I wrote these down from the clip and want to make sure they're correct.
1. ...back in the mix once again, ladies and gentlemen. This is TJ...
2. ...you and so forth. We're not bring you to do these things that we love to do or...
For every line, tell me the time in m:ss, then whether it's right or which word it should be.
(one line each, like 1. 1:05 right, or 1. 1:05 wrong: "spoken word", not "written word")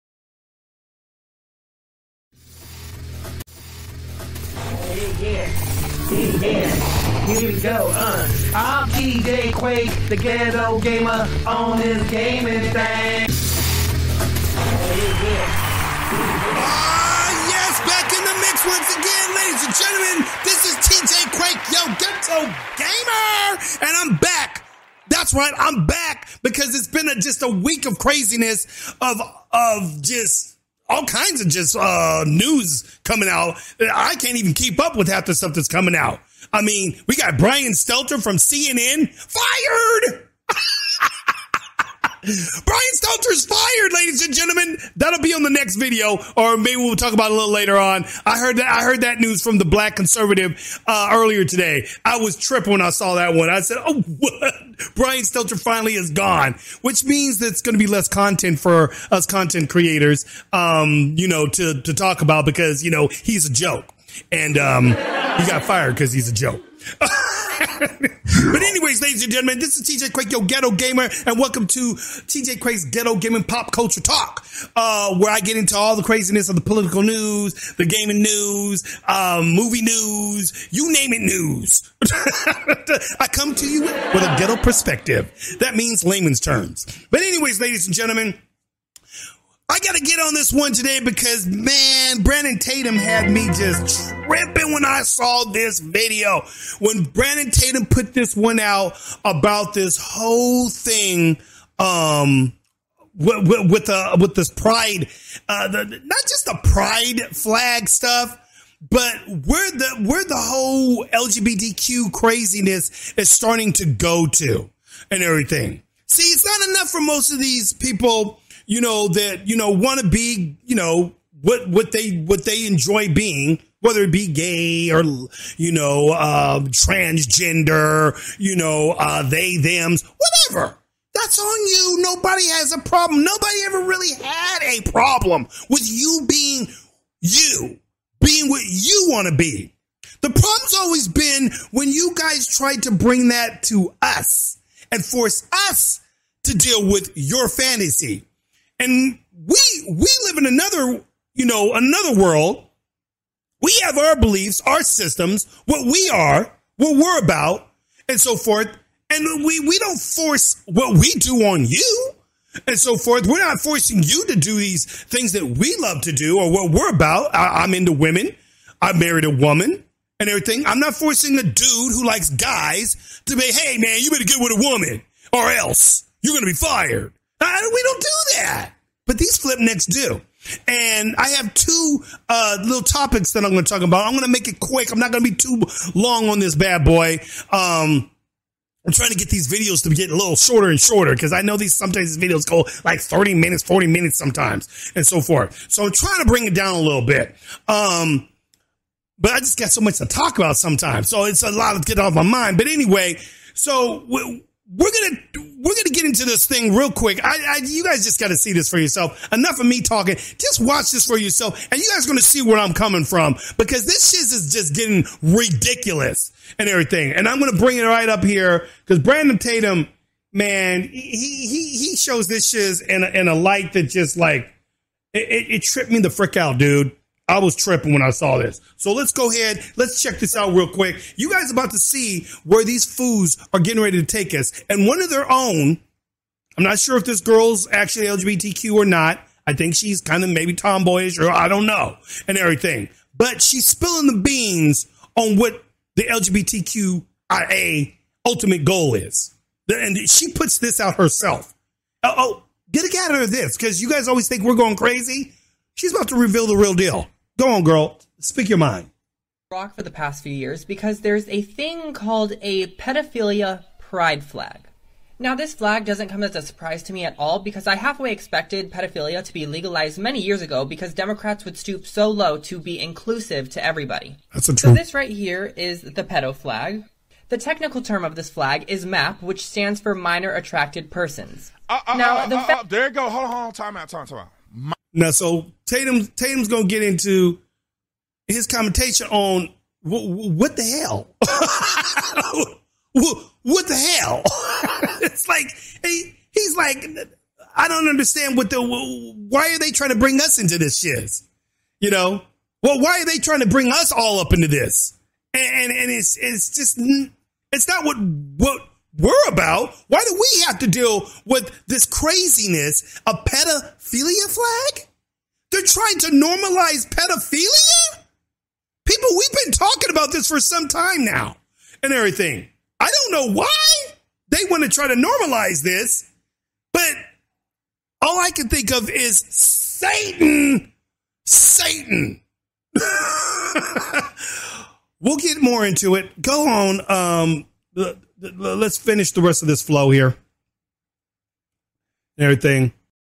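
1. 0:17 right
2. 2:41 wrong: "forcing", not "bring".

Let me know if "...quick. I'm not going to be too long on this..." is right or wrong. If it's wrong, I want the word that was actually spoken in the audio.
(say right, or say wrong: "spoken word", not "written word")
right.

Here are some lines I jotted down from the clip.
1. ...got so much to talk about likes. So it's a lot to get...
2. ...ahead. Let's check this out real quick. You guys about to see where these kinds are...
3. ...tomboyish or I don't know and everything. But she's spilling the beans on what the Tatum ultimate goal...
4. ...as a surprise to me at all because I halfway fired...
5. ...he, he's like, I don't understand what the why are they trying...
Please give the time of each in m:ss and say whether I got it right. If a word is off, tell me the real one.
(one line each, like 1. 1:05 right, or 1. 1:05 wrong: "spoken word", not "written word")
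1. 3:19 wrong: "sometimes", not "likes"
2. 3:49 wrong: "foods", not "kinds"
3. 4:00 wrong: "LGBTQIA", not "Tatum"
4. 4:26 wrong: "expected", not "fired"
5. 4:55 right.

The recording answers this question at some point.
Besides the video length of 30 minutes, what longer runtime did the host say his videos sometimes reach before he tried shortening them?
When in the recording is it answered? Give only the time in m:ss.
3:13.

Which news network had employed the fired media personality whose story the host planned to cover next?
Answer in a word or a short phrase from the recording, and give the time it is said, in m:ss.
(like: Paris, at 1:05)
CNN, at 0:38.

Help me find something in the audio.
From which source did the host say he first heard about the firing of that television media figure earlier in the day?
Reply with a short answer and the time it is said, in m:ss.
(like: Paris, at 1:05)
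the Black Conservative, at 0:49.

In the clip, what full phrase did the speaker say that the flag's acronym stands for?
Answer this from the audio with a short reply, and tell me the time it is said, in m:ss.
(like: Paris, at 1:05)
Minor Attracted Persons, at 4:39.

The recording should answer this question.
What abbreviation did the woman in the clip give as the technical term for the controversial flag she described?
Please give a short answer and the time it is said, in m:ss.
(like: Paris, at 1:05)
MAP, at 4:38.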